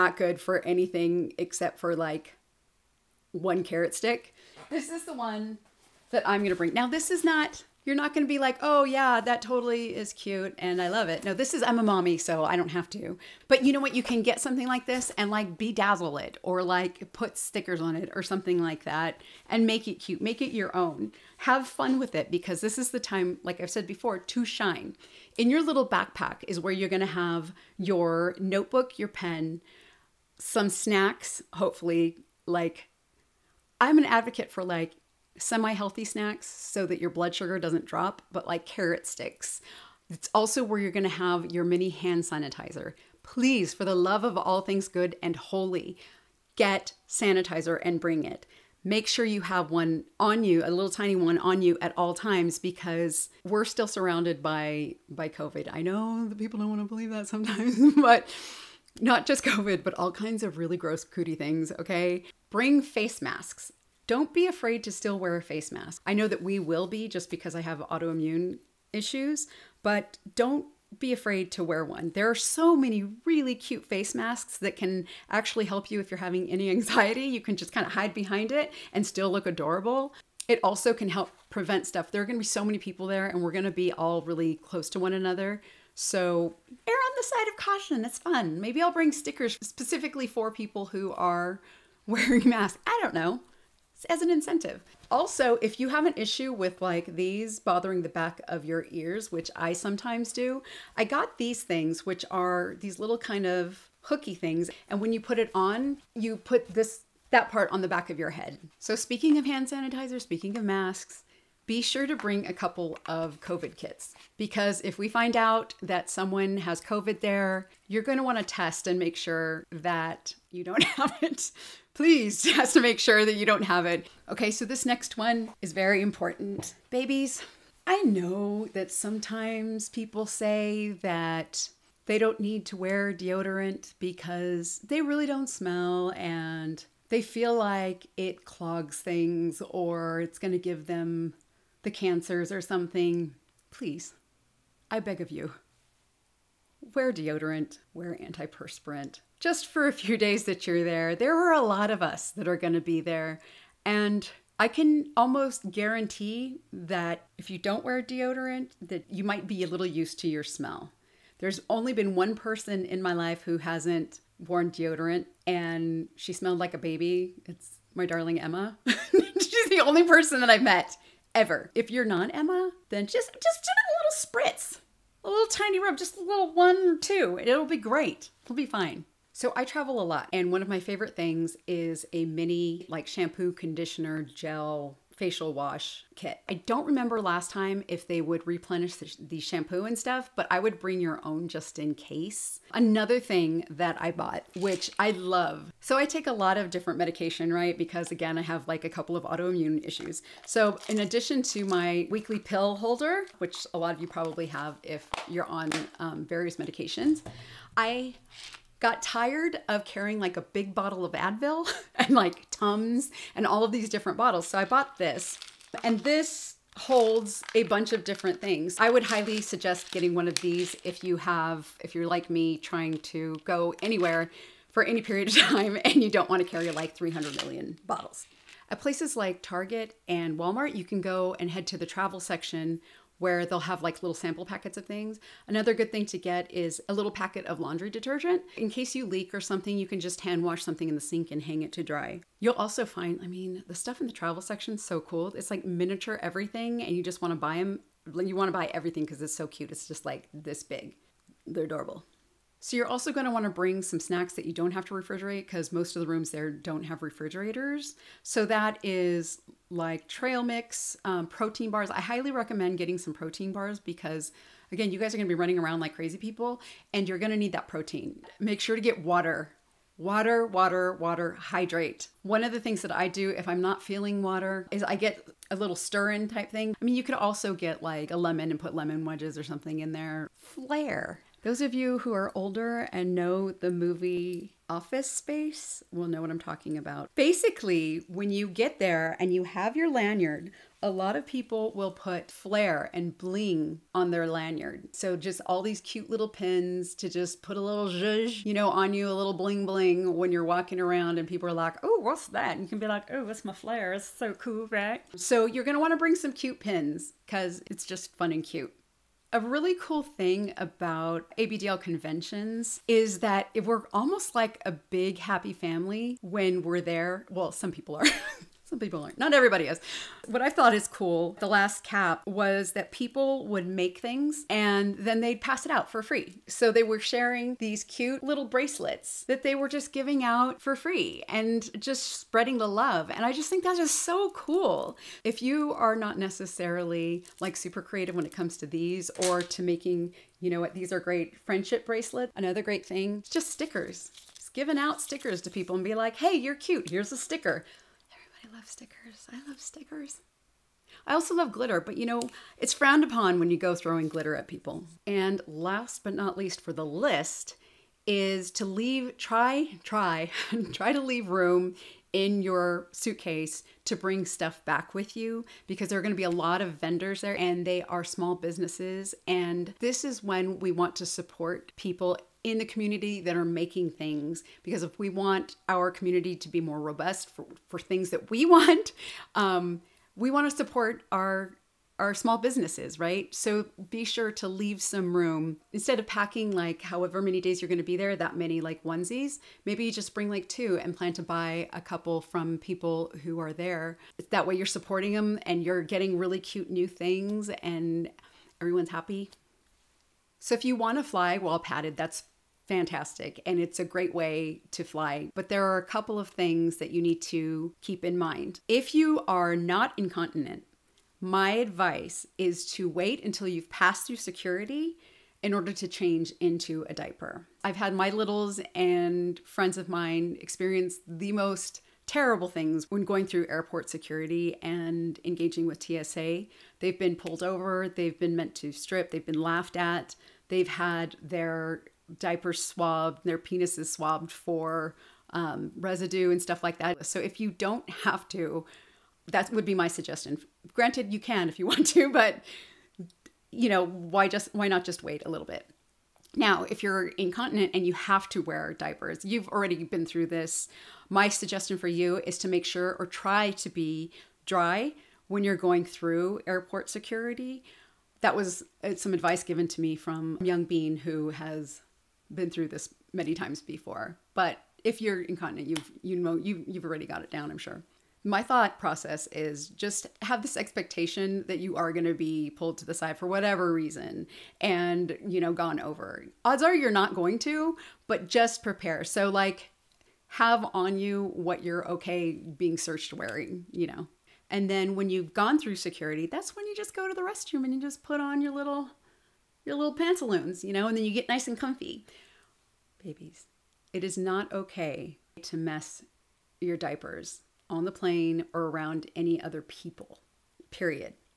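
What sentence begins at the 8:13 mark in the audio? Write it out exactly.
Babies, it is not okay to mess your diapers on the plane or around any other people, period.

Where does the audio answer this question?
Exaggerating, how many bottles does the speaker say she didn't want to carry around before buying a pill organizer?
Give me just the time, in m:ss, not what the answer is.
3:46.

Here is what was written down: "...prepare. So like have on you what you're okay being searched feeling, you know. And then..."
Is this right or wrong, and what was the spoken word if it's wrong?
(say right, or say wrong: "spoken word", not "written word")
wrong: "wearing", not "feeling".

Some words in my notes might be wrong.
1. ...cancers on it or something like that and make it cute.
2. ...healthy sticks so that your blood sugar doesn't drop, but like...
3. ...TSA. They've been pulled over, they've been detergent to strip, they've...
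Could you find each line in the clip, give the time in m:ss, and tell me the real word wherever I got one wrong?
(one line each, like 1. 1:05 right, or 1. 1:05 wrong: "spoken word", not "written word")
1. 0:17 wrong: "stickers", not "cancers"
2. 0:35 wrong: "snacks", not "sticks"
3. 7:05 wrong: "meant", not "detergent".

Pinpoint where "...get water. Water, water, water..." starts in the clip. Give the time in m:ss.
4:28.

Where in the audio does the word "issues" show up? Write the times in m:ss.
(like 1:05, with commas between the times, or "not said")
1:08, 1:36, 3:19.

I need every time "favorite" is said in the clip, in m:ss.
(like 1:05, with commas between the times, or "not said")
3:00.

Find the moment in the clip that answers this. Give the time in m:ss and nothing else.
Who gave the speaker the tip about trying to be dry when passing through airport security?
7:40.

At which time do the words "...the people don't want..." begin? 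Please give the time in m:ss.
0:56.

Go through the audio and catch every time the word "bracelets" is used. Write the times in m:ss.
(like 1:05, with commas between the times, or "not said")
5:28, 5:41.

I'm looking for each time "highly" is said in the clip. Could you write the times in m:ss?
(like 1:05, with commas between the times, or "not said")
3:39, 4:21.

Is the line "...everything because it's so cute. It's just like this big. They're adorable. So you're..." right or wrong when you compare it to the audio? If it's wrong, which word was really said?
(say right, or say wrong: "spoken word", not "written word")
right.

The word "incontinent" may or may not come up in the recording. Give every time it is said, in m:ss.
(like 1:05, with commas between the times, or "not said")
6:49, 7:27, 7:45.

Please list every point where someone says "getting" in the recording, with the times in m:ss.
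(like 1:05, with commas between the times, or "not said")
3:39, 4:22, 6:35.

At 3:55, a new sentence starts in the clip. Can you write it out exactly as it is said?
Another good thing to get is a little packet of laundry detergent.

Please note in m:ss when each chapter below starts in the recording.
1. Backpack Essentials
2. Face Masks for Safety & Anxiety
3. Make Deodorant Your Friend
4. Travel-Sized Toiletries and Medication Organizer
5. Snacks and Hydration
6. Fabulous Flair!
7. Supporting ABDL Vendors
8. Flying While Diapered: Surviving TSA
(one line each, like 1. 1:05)
1. 0:25
2. 1:02
3. 2:04
4. 2:59
5. 4:12
6. 4:40
7. 5:55
8. 6:40.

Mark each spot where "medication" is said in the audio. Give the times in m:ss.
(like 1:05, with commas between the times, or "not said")
3:16, 3:26.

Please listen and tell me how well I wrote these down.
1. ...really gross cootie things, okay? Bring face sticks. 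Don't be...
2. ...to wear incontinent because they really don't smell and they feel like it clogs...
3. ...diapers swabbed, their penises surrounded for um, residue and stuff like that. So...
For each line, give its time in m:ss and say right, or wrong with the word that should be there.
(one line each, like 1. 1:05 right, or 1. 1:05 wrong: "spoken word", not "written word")
1. 1:00 wrong: "masks", not "sticks"
2. 2:12 wrong: "deodorant", not "incontinent"
3. 7:12 wrong: "swabbed", not "surrounded".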